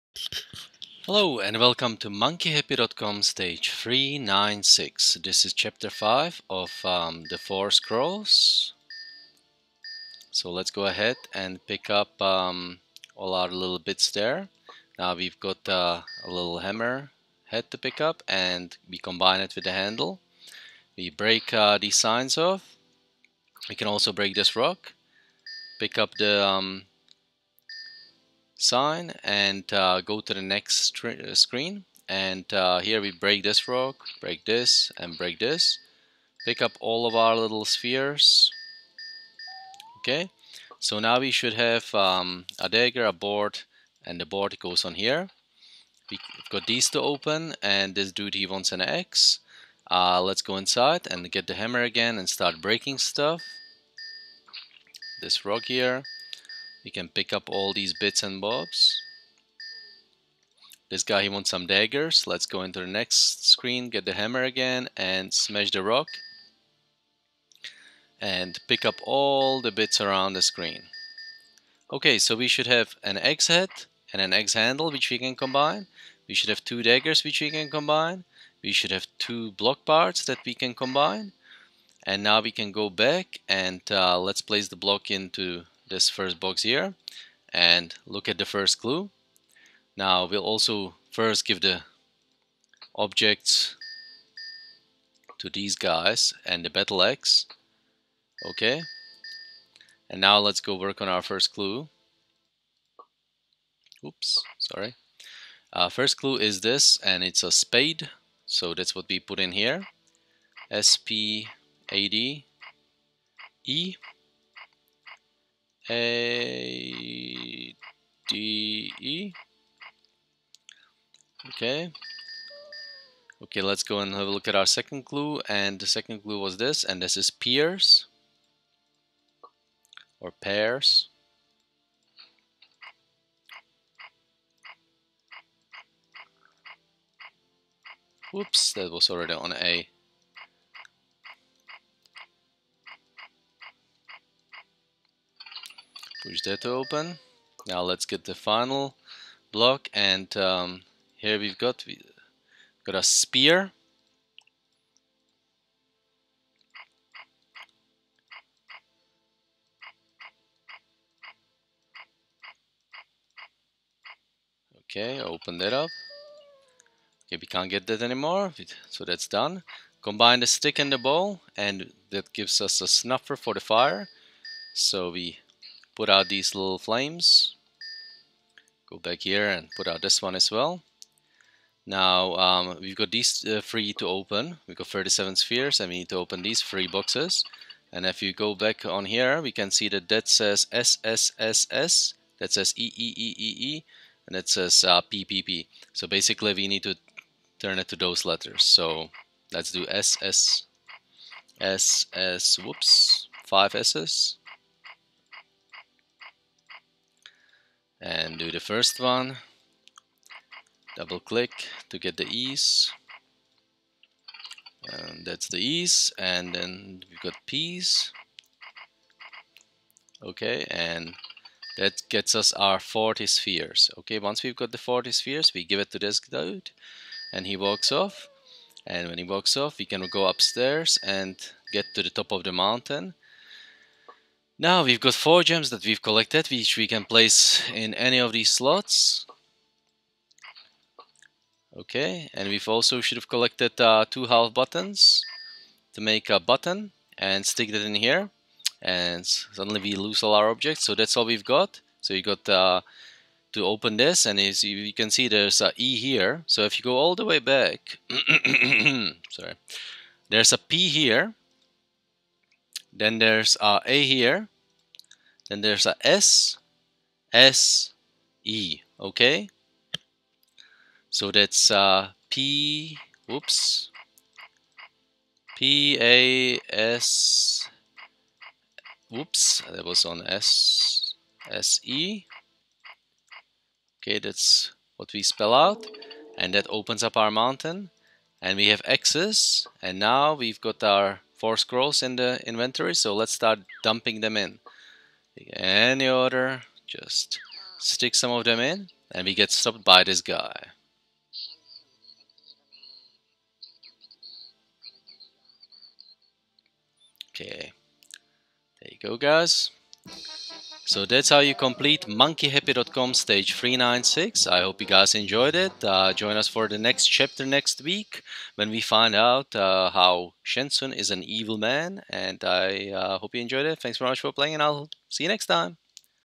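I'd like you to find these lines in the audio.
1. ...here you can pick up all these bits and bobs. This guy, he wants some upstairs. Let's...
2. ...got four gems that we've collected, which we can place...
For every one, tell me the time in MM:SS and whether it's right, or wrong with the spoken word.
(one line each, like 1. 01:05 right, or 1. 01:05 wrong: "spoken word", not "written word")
1. 00:55 wrong: "daggers", not "upstairs"
2. 03:54 right.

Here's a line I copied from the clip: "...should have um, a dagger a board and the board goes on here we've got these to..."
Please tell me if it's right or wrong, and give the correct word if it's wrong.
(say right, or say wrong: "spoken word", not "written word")
right.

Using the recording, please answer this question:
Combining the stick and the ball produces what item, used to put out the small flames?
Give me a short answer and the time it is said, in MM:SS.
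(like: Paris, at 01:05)
A snuffer, at 02:52.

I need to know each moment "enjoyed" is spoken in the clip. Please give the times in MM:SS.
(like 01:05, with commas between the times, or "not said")
05:15, 05:23.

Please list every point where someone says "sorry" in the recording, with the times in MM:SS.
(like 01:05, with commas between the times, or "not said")
01:44, 04:19.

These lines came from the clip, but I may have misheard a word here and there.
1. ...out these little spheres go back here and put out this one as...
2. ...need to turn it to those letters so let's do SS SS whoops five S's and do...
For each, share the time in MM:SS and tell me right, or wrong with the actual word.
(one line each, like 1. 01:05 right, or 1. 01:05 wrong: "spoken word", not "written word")
1. 02:56 wrong: "flames", not "spheres"
2. 03:16 right.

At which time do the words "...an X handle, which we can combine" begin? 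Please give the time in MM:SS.
01:14.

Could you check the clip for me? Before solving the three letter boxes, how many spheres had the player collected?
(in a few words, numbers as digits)
37.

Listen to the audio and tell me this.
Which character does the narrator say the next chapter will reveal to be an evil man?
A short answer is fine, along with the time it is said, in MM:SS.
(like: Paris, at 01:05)
Shensun, at 05:20.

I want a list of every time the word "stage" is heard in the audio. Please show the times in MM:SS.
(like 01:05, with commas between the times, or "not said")
00:03, 05:13.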